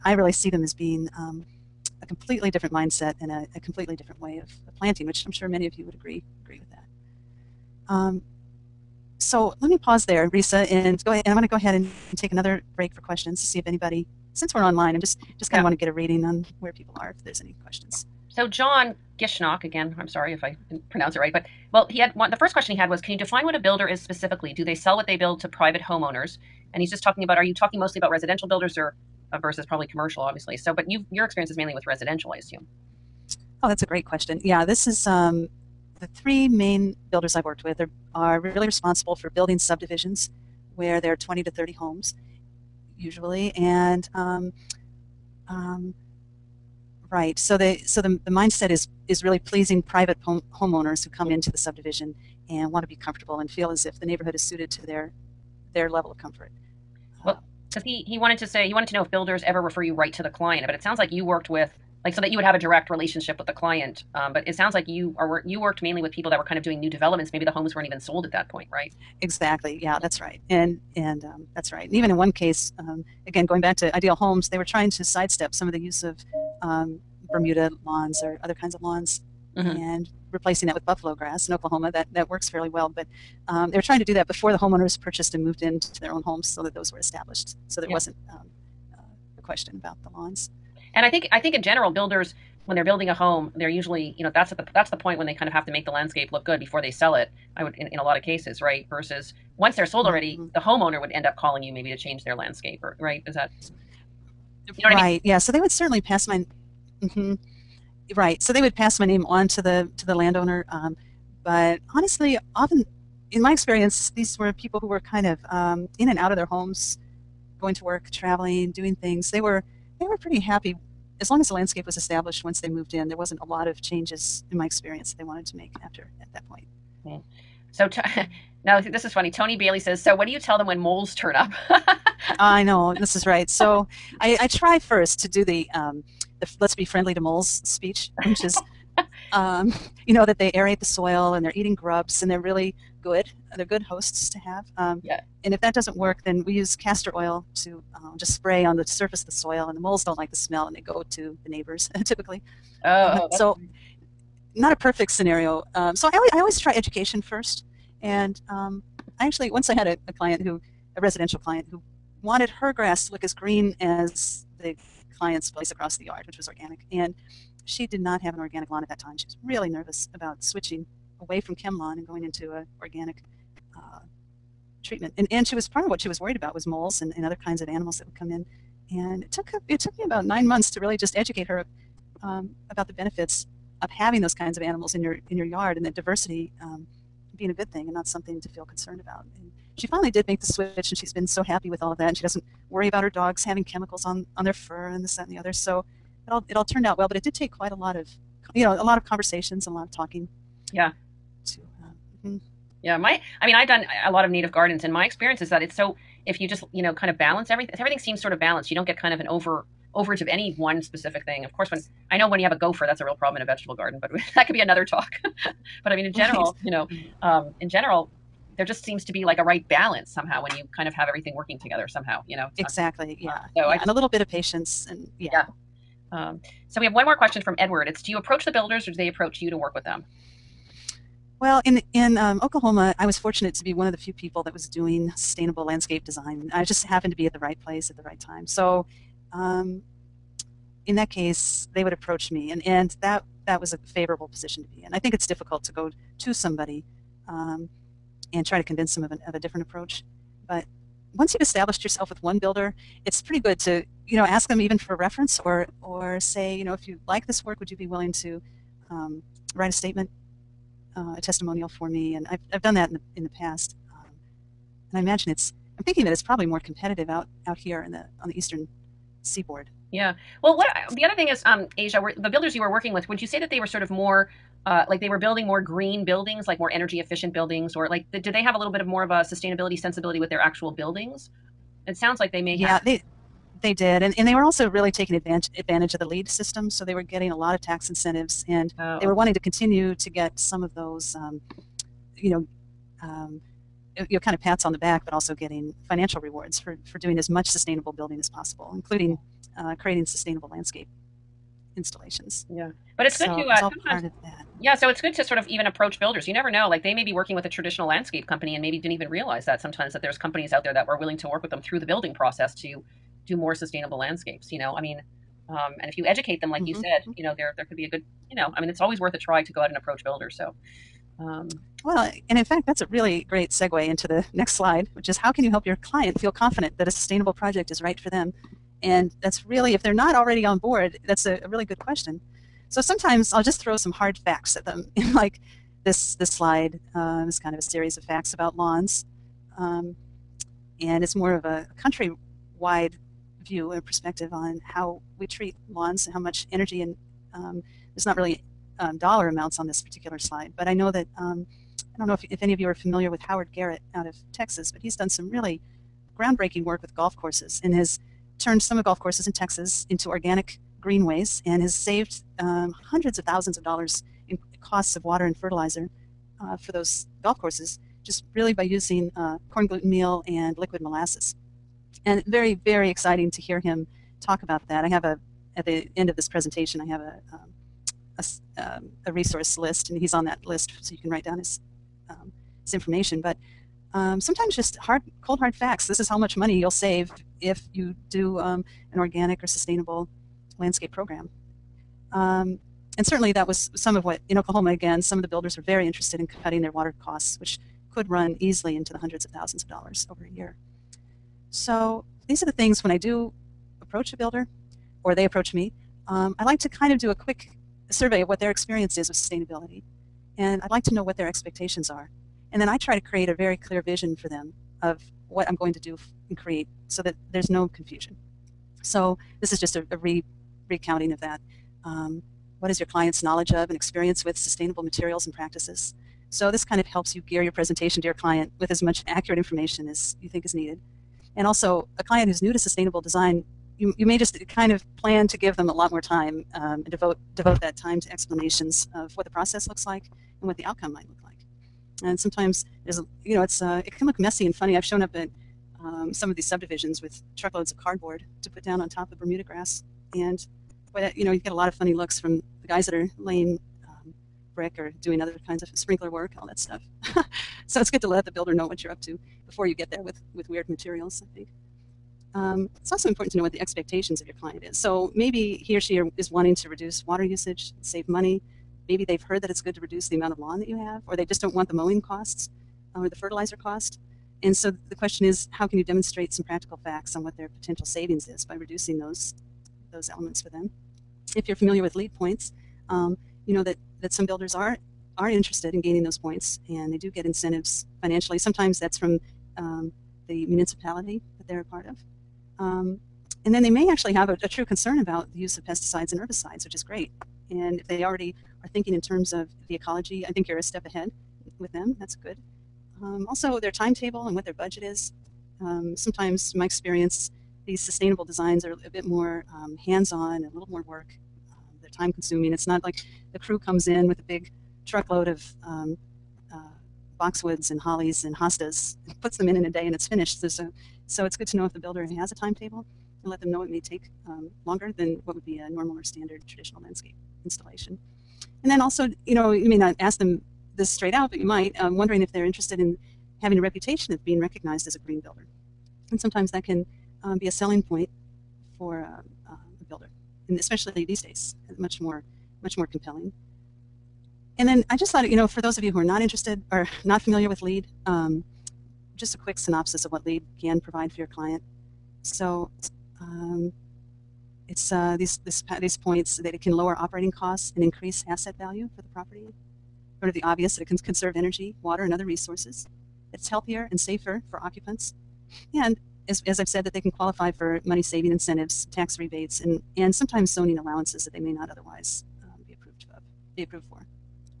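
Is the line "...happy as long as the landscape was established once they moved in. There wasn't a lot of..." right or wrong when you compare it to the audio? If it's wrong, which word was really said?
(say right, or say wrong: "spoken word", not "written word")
right.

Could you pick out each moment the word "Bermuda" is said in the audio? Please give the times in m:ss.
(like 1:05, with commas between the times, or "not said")
1:17, 7:29.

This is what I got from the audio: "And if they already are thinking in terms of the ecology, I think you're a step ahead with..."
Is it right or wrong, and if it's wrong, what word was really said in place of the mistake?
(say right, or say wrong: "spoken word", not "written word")
right.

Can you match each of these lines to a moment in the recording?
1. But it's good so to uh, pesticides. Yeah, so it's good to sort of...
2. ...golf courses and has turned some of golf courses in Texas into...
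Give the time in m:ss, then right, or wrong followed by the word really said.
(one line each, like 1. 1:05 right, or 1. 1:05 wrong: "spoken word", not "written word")
1. 5:02 wrong: "sometimes", not "pesticides"
2. 5:56 right.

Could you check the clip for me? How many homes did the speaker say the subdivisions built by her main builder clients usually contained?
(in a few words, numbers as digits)
20 to 30.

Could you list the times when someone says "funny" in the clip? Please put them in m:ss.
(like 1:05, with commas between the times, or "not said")
2:09, 2:33, 7:24, 7:31.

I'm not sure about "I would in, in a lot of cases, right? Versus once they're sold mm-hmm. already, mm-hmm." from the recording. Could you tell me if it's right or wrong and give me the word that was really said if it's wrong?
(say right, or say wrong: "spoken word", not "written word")
right.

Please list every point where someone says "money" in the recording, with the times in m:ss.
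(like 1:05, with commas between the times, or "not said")
6:26, 7:48, 9:27.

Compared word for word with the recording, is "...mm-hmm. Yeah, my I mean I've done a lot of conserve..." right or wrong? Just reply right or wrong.
wrong.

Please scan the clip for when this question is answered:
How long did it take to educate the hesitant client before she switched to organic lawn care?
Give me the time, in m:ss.
3:00.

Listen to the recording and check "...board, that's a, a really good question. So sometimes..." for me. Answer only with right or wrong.
right.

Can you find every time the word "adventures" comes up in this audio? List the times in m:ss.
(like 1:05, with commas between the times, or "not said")
not said.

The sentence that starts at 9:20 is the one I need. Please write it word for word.
Sort of the obvious that it can conserve energy, water, and other resources.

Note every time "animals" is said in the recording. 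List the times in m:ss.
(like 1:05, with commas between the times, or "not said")
2:57, 3:04.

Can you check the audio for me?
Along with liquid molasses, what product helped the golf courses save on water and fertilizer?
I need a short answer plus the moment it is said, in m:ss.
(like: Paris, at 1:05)
corn gluten meal, at 6:09.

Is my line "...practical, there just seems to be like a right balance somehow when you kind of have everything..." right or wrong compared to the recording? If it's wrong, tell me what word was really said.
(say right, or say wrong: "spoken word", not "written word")
wrong: "general", not "practical".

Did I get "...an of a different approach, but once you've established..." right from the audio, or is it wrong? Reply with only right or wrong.
right.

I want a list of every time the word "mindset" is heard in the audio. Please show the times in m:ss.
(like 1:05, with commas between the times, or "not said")
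0:02, 0:48.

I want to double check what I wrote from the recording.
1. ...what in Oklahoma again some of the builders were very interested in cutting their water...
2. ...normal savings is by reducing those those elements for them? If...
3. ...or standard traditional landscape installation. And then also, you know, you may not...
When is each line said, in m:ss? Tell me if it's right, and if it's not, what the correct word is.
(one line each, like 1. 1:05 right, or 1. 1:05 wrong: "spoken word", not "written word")
1. 6:34 right
2. 7:57 wrong: "potential", not "normal"
3. 8:45 right.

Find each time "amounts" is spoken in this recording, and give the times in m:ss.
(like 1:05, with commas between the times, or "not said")
5:49, 7:50.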